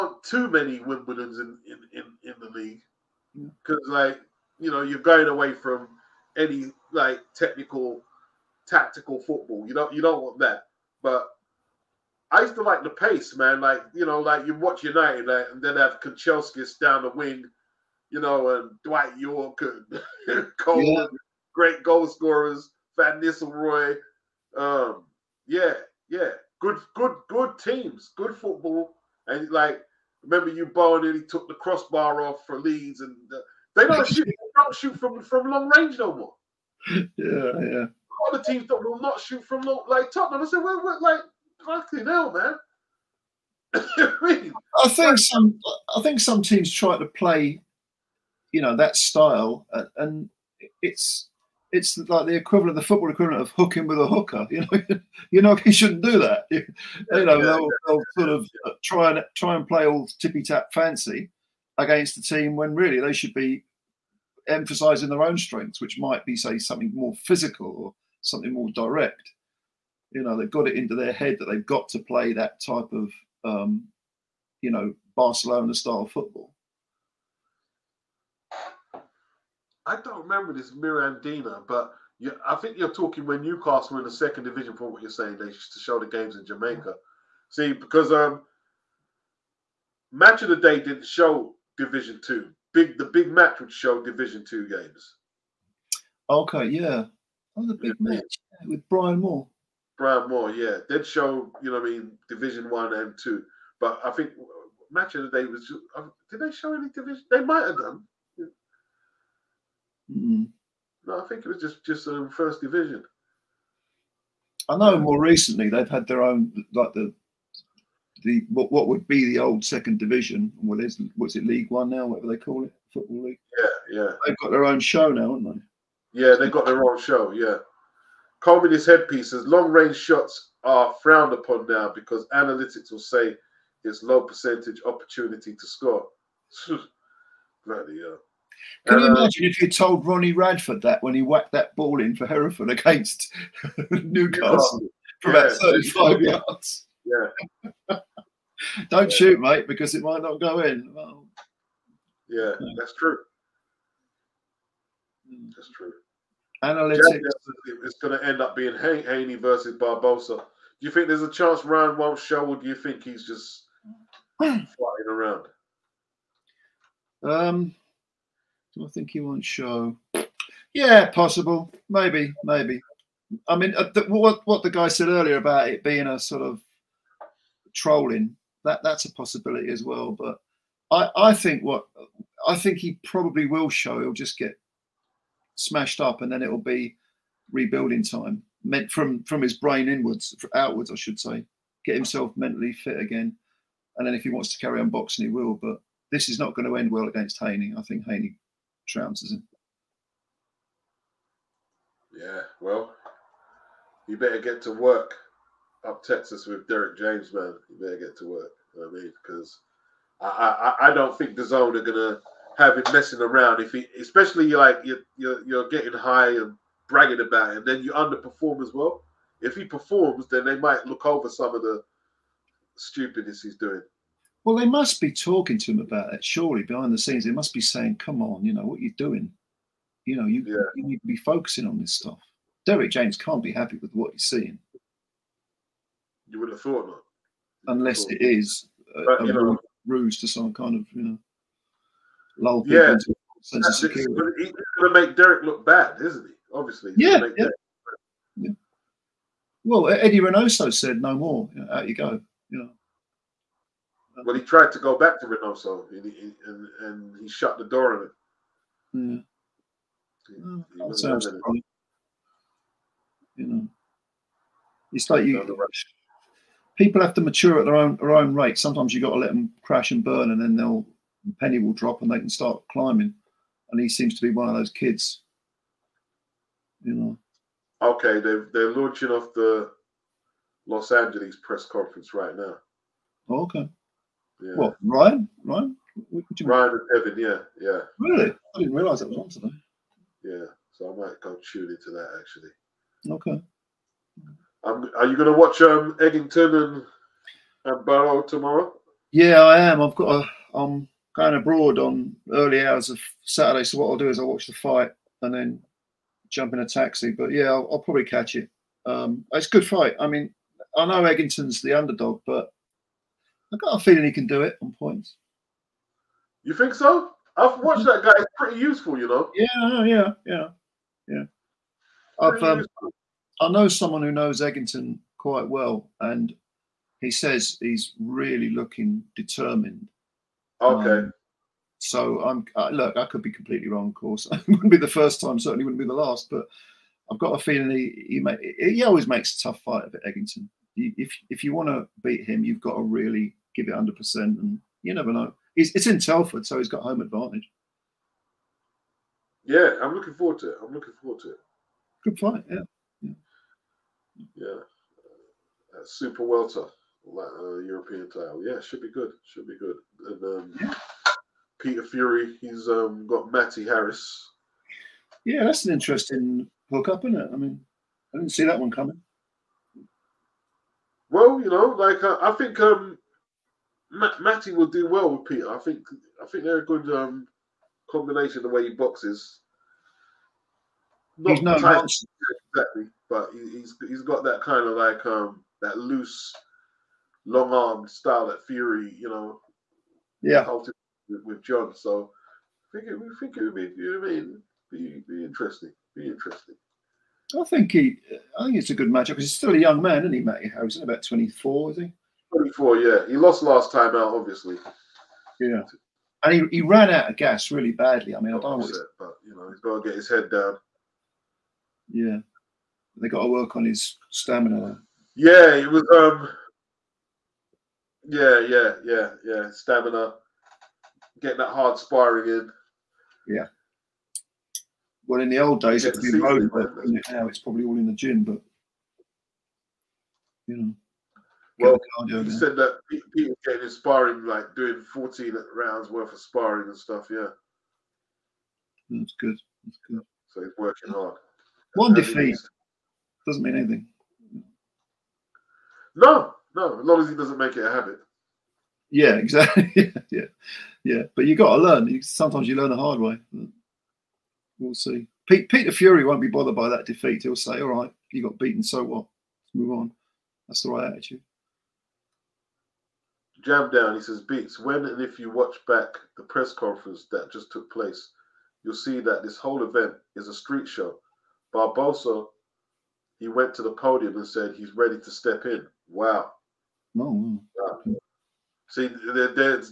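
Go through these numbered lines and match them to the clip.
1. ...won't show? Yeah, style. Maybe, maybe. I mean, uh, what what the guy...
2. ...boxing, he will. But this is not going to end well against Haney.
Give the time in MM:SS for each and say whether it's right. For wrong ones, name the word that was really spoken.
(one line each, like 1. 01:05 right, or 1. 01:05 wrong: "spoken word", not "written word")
1. 02:49 wrong: "possible", not "style"
2. 03:14 right.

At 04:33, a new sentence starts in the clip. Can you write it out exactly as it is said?
And he seems to be one of those kids, you know.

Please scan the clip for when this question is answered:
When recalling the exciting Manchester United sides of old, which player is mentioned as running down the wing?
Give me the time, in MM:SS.
00:16.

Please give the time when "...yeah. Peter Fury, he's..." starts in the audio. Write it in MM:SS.
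06:00.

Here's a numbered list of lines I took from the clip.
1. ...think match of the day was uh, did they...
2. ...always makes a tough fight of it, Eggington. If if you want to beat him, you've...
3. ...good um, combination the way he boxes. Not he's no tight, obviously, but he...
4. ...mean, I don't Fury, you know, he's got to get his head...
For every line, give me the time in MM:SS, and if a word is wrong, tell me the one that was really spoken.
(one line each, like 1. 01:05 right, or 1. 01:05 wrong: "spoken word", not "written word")
1. 01:44 right
2. 05:38 right
3. 06:16 wrong: "exactly", not "obviously"
4. 06:48 wrong: "But", not "Fury".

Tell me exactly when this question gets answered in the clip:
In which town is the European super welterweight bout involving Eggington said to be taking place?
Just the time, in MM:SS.
05:45.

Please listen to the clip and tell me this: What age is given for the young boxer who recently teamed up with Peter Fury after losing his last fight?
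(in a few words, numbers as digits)
24.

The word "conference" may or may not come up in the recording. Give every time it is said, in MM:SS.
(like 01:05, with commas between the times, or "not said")
04:41, 07:46.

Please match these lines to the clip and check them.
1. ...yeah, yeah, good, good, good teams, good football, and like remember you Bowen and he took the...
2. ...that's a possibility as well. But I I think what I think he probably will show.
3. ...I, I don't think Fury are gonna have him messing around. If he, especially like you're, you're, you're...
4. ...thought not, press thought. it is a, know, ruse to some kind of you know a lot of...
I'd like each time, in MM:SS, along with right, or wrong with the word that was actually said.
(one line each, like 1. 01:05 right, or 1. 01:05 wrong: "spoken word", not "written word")
1. 00:25 right
2. 02:58 right
3. 03:30 wrong: "DAZN", not "Fury"
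4. 03:56 wrong: "unless", not "press".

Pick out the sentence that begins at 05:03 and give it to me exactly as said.
So what I'll do is I'll watch the fight and then jump in a taxi.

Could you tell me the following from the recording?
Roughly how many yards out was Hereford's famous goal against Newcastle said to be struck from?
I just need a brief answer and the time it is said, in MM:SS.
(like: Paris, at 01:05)
35, at 02:25.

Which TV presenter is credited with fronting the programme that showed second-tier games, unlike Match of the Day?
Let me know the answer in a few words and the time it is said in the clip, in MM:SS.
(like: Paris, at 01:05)
Brian Moore, at 01:40.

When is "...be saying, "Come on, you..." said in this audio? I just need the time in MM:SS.
03:47.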